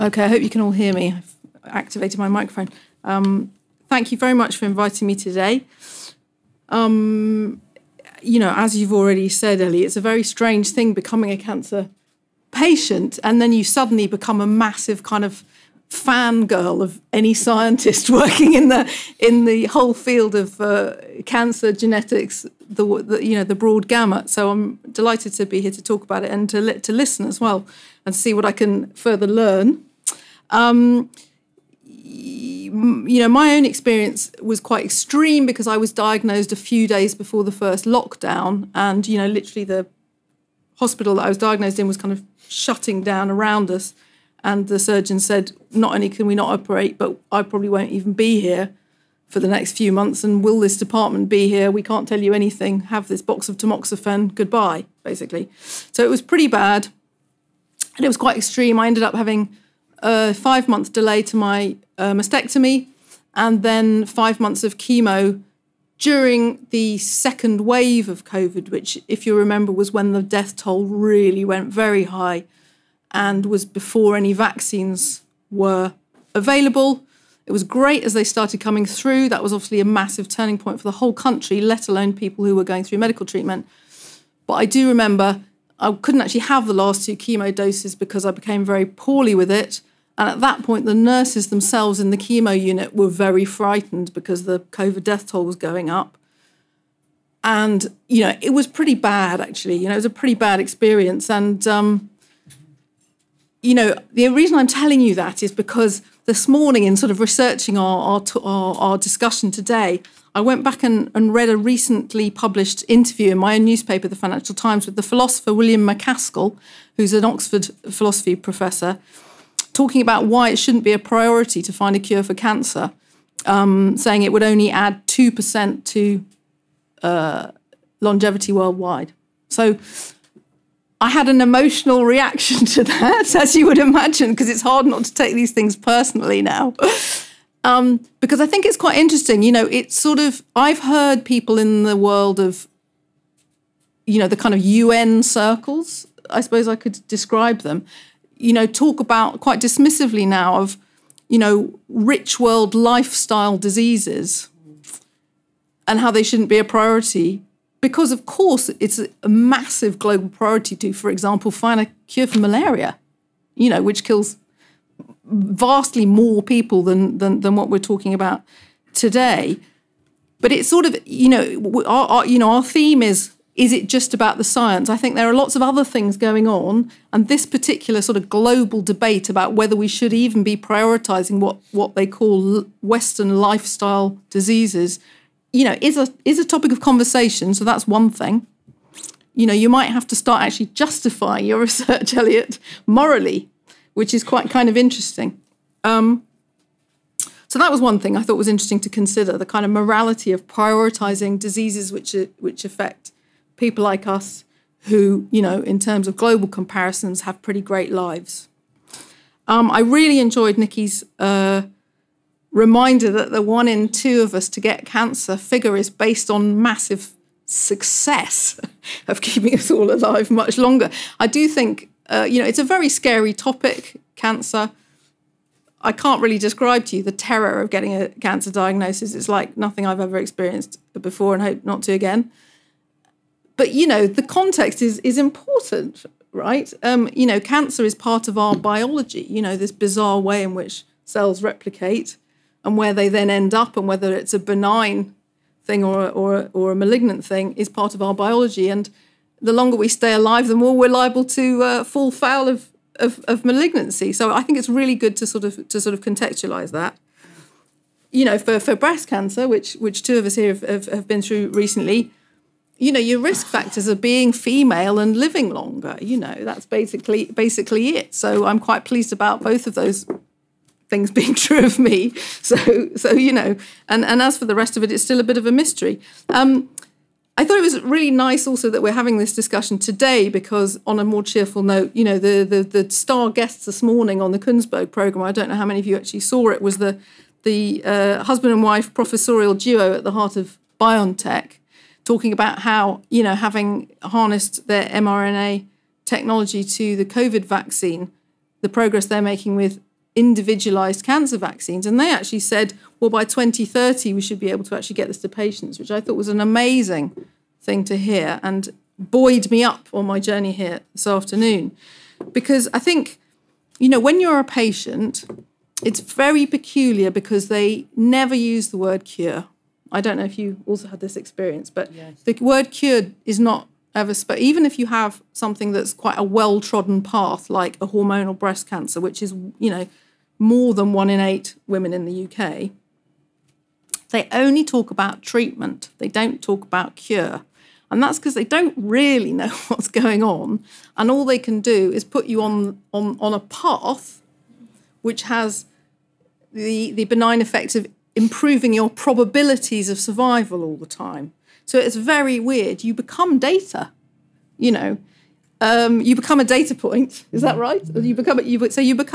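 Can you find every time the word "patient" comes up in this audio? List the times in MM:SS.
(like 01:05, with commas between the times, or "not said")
00:12, 05:05, 05:14.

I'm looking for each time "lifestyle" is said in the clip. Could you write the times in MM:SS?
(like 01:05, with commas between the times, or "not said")
02:32, 03:03.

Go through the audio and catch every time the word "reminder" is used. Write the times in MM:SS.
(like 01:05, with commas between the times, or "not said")
03:32.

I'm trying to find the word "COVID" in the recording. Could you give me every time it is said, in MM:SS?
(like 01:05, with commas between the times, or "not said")
01:08, 01:34, 04:57.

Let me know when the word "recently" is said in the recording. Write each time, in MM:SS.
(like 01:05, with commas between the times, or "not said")
01:51, 04:21.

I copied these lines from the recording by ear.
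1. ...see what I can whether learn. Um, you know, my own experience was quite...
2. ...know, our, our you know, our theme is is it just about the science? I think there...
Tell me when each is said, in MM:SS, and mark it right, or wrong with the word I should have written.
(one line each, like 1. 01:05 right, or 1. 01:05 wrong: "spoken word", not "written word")
1. 00:28 wrong: "further", not "whether"
2. 02:51 right.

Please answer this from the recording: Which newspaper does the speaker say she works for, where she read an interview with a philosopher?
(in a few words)
Financial Times.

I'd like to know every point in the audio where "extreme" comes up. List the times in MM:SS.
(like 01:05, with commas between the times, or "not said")
00:34, 00:58.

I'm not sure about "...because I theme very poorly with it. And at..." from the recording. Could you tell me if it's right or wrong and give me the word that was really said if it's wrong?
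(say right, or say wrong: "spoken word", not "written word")
wrong: "became", not "theme".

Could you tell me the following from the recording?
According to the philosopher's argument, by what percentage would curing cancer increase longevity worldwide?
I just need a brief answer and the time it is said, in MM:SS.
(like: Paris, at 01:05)
2%, at 02:05.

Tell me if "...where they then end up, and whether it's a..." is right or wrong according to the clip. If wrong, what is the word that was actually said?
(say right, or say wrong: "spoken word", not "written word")
right.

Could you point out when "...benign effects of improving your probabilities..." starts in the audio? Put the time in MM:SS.
05:47.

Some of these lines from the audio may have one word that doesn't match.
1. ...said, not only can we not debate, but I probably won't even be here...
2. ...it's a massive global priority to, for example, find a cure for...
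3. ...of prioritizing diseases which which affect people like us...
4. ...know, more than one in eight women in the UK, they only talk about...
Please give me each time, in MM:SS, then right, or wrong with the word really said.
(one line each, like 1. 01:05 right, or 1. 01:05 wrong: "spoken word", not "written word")
1. 00:45 wrong: "operate", not "debate"
2. 02:38 right
3. 03:20 right
4. 05:29 right.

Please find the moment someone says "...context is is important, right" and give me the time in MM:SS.
03:54.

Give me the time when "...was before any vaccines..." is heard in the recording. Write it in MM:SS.
01:13.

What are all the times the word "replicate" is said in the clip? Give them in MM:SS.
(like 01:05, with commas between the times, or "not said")
04:01.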